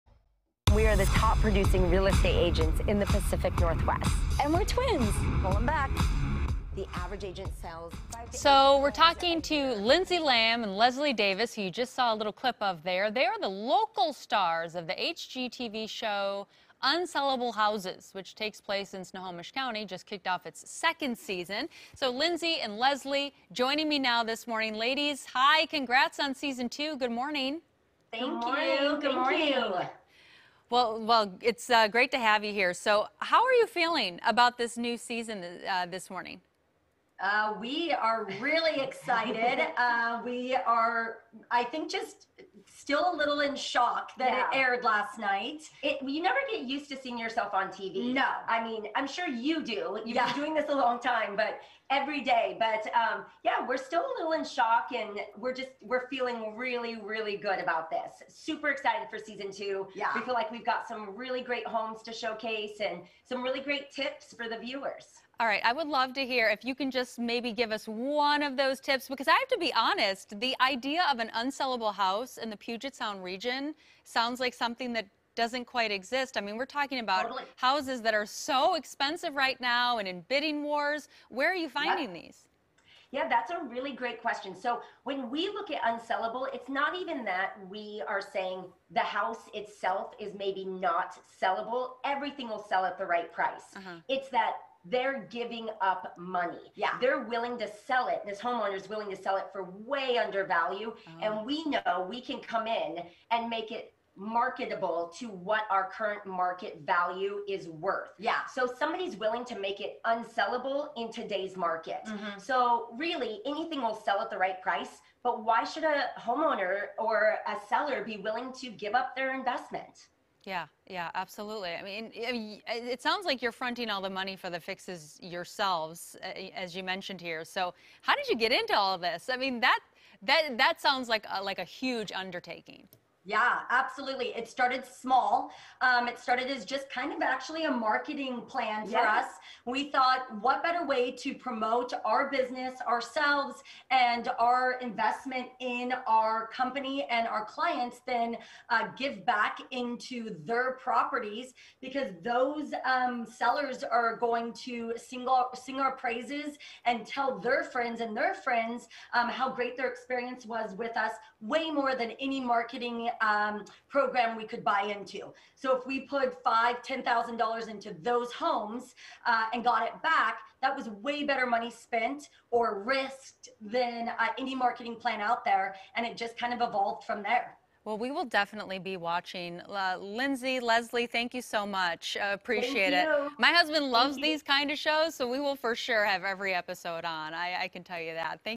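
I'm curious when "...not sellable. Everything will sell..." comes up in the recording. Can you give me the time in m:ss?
1:30.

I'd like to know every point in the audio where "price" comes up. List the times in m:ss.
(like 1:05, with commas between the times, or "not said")
1:33, 1:54.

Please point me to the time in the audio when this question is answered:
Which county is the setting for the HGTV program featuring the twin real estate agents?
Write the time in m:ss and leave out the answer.
0:19.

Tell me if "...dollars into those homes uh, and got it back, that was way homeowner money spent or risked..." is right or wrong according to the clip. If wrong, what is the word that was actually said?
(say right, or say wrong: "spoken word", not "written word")
wrong: "better", not "homeowner".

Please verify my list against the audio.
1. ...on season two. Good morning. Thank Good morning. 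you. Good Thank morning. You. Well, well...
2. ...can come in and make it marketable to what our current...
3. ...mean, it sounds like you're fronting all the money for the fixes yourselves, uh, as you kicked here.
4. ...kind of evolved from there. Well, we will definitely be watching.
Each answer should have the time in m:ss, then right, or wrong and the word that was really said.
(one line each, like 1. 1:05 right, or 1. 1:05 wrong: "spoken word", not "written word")
1. 0:26 right
2. 1:42 right
3. 2:01 wrong: "mentioned", not "kicked"
4. 2:56 right.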